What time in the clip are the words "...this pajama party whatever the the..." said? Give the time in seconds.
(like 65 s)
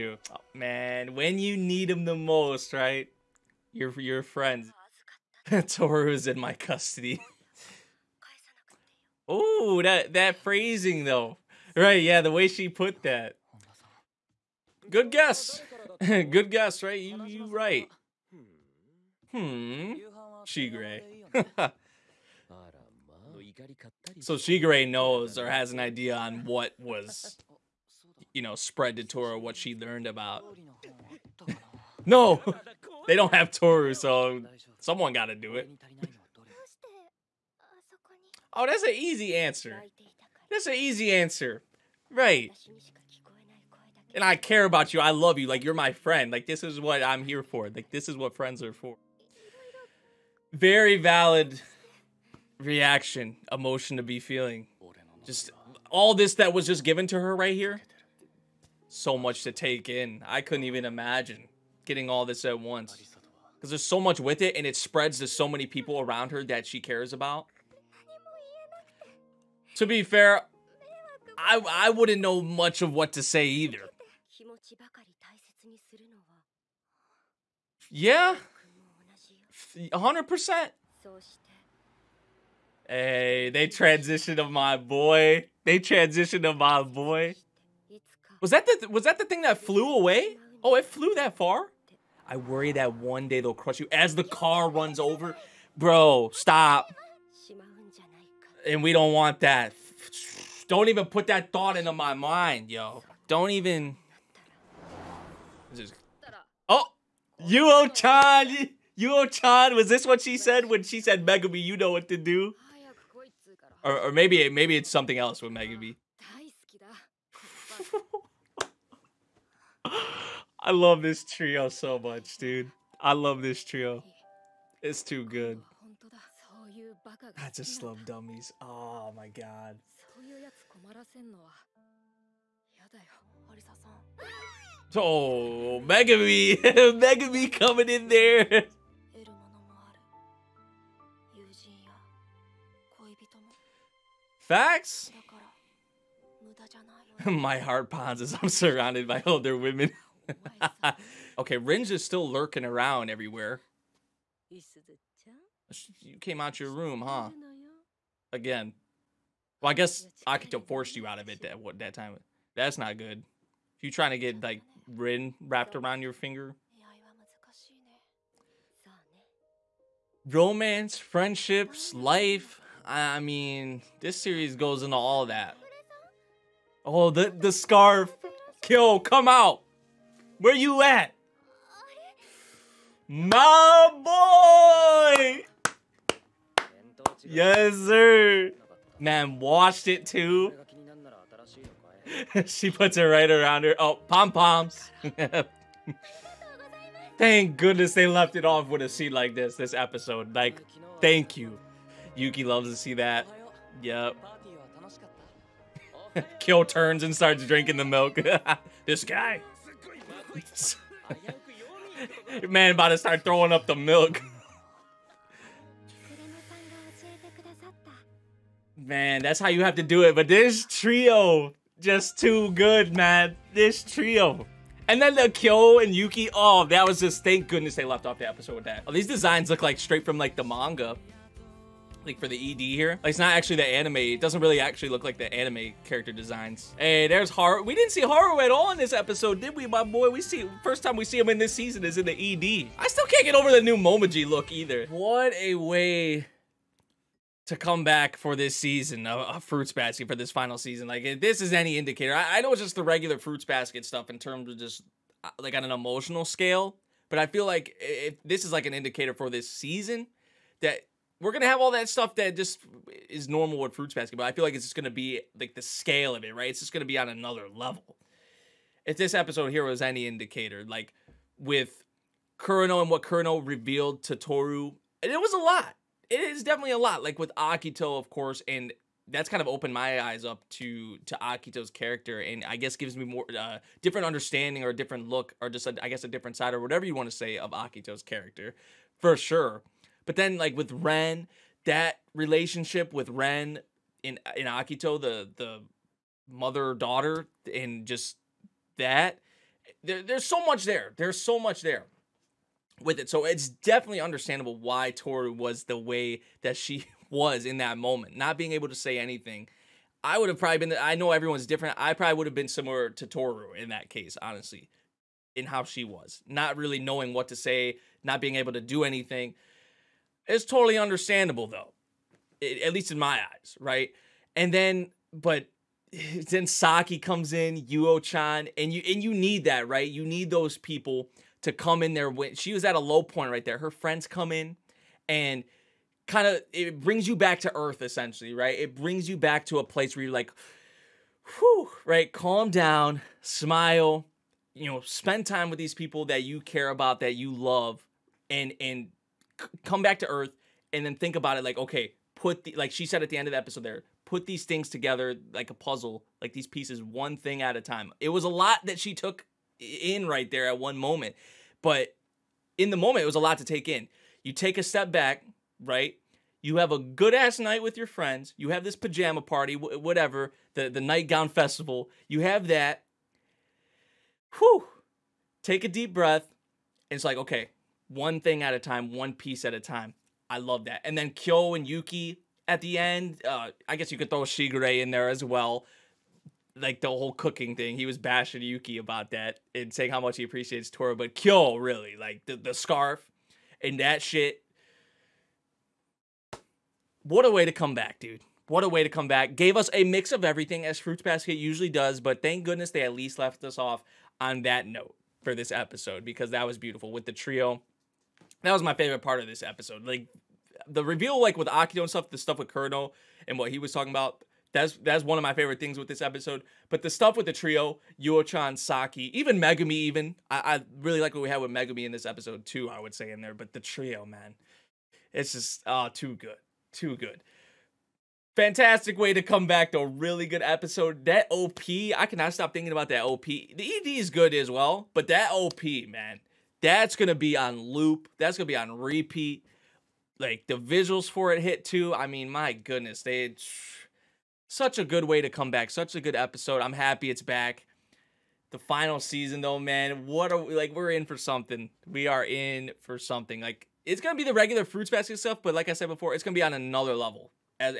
368 s.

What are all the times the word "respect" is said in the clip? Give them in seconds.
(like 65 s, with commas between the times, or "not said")
not said.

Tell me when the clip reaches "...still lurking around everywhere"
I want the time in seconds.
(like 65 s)
152 s.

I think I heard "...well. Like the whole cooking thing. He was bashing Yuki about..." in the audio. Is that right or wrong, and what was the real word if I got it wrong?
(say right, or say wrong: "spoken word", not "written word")
right.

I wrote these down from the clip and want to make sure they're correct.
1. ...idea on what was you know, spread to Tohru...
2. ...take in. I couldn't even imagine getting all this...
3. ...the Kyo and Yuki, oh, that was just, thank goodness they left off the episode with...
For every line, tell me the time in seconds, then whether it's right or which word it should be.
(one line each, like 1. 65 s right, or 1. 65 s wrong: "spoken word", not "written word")
1. 25 s right
2. 59 s right
3. 225 s right.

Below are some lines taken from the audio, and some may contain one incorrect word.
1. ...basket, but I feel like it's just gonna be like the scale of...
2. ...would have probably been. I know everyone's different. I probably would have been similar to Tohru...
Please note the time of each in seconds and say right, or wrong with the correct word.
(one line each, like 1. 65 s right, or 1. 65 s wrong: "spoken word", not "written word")
1. 263 s right
2. 310 s right.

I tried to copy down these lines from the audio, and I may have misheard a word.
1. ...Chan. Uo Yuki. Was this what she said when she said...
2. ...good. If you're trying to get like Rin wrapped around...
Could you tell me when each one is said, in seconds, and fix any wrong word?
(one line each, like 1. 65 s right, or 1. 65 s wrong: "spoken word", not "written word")
1. 107 s wrong: "Chan", not "Yuki"
2. 162 s right.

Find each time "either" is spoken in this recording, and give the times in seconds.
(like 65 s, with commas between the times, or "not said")
73 s, 244 s.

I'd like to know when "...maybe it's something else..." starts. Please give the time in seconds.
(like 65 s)
114 s.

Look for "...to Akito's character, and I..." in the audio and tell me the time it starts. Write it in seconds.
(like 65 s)
281 s.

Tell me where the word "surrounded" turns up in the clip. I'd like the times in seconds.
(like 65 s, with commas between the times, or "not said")
148 s.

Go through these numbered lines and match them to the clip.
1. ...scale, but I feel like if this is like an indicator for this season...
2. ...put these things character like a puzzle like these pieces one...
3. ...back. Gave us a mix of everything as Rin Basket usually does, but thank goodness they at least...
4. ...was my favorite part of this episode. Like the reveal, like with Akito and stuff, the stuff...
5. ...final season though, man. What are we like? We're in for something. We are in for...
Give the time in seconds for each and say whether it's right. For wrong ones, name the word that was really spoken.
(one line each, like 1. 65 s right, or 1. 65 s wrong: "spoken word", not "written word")
1. 256 s right
2. 354 s wrong: "together", not "character"
3. 399 s wrong: "Fruits", not "Rin"
4. 408 s right
5. 448 s right.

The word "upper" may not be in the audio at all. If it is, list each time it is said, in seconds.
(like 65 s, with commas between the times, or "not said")
not said.